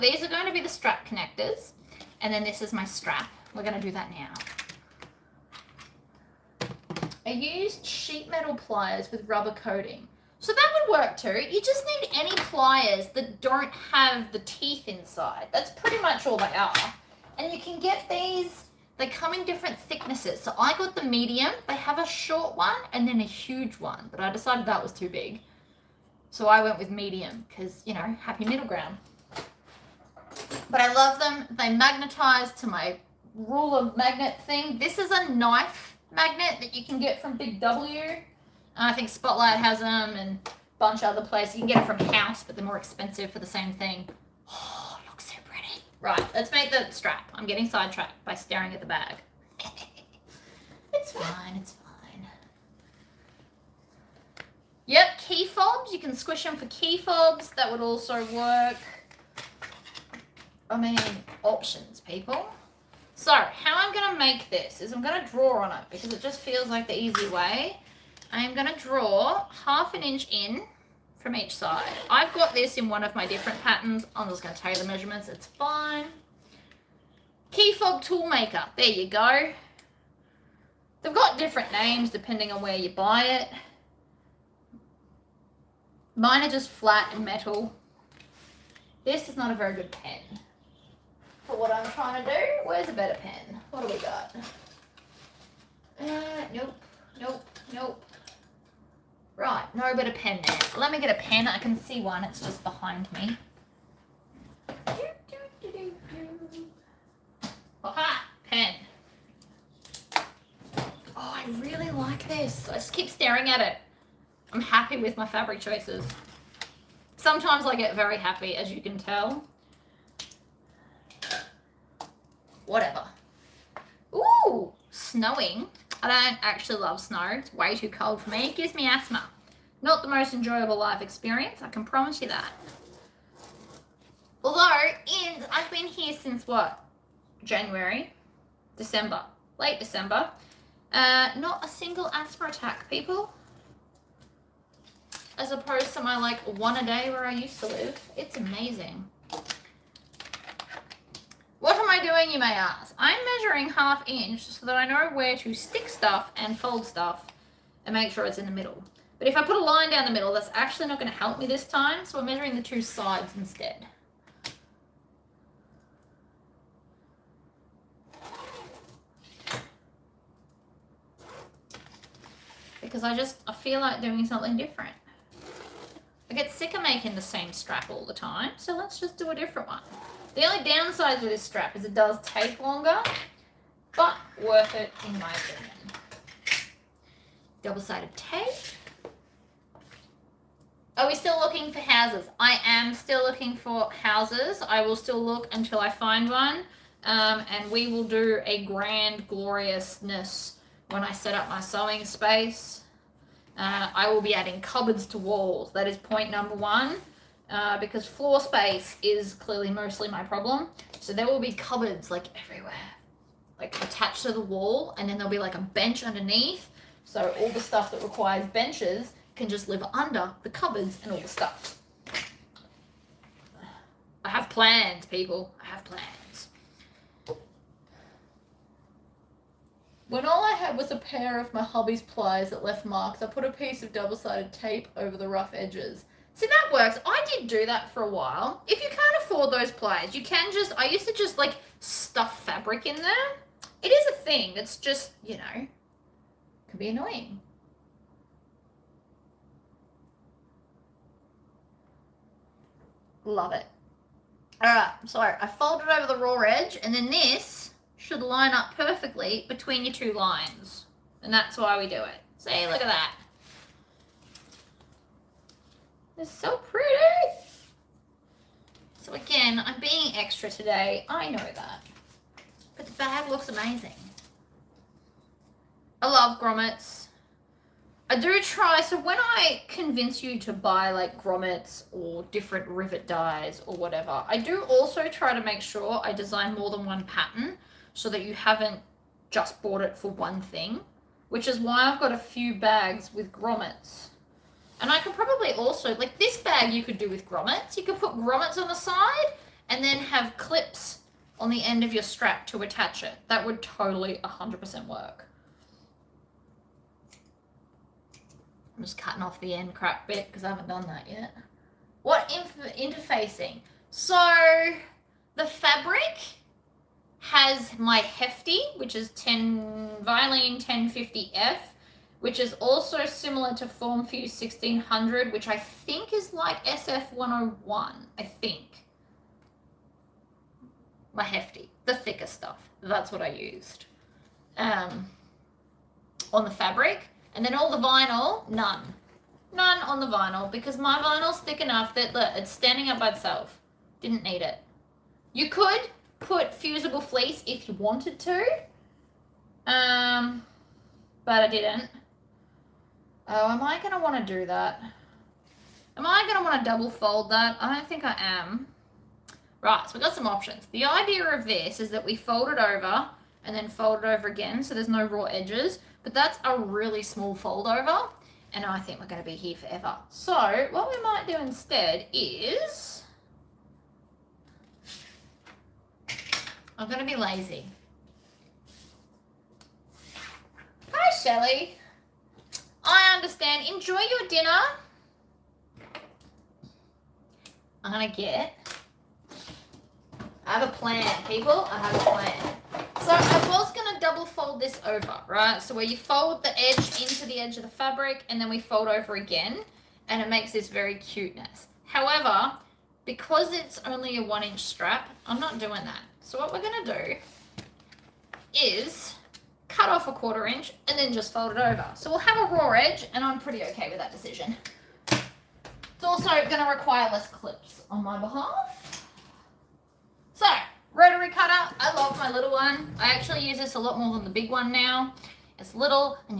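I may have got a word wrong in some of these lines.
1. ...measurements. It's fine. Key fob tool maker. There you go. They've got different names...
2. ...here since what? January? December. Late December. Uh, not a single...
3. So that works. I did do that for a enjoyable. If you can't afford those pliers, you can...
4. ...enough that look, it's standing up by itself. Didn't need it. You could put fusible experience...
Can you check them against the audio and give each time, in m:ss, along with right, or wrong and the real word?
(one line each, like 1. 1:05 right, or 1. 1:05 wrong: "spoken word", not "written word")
1. 1:14 right
2. 2:15 right
3. 3:56 wrong: "while", not "enjoyable"
4. 5:41 wrong: "fleece", not "experience".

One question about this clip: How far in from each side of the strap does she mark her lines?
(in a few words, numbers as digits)
Half an inch.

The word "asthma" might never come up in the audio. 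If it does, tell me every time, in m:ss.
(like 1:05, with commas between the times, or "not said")
2:08, 2:22.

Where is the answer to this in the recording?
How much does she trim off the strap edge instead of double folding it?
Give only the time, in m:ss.
6:50.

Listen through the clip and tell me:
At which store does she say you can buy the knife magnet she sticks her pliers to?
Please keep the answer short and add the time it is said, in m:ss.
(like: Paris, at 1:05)
Big W, at 0:37.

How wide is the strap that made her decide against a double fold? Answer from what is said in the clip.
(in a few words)
One inch.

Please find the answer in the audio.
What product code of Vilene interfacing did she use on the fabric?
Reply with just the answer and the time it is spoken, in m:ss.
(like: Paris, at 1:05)
1050F, at 5:20.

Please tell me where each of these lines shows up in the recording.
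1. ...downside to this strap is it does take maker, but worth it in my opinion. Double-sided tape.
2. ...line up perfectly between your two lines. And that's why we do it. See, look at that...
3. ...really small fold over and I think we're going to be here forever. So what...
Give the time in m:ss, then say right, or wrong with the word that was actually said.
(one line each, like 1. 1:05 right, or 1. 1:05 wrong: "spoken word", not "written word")
1. 3:00 wrong: "longer", not "maker"
2. 4:18 right
3. 6:06 right.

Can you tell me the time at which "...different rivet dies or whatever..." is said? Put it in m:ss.
4:42.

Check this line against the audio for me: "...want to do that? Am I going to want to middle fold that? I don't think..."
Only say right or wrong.
wrong.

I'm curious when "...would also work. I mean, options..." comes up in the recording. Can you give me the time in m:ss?
0:57.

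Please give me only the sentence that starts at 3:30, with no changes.
So there will be cupboards like everywhere, like attached to the wall, and then there'll be like a bench underneath.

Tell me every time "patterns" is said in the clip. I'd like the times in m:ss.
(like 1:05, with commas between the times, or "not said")
1:13, 4:47.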